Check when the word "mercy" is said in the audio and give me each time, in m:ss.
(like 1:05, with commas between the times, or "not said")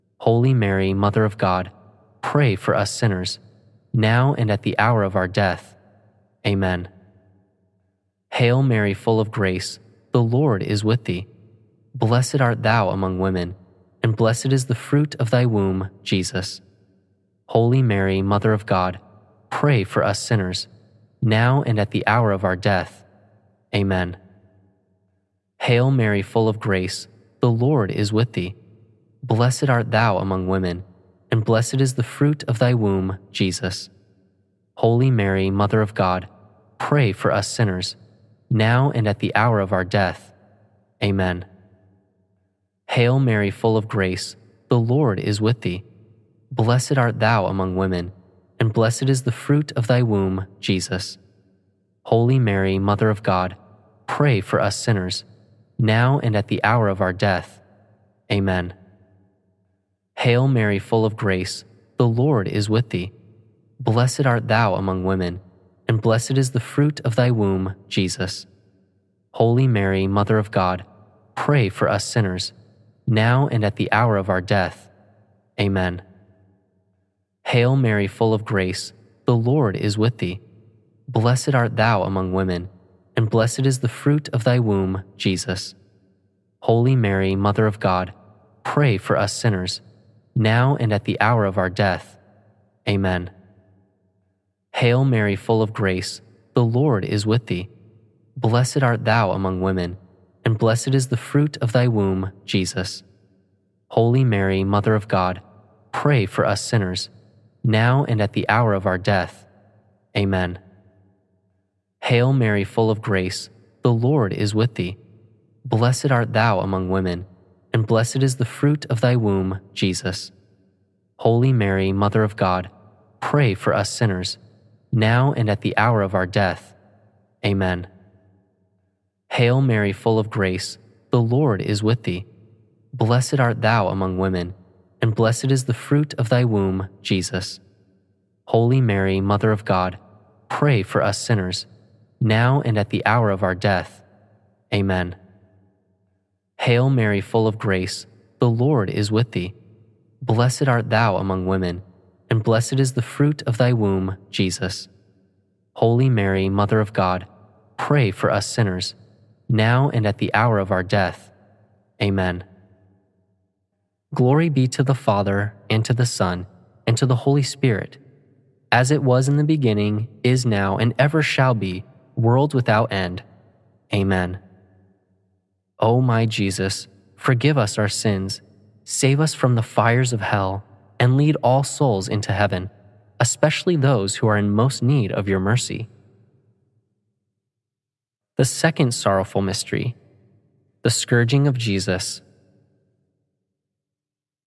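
3:05.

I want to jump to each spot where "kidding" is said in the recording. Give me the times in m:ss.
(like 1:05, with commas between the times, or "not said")
not said.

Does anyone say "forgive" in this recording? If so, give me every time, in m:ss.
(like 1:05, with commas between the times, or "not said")
2:57.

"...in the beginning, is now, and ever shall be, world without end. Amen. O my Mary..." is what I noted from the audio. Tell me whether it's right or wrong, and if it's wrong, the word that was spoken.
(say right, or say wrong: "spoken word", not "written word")
wrong: "Jesus", not "Mary".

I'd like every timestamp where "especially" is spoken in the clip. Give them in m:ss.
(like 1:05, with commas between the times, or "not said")
3:03.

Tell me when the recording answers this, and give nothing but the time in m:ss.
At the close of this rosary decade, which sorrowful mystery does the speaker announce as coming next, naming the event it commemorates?
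3:10.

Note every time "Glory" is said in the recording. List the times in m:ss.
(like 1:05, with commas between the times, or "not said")
2:44.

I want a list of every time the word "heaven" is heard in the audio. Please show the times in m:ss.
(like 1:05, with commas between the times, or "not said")
3:02.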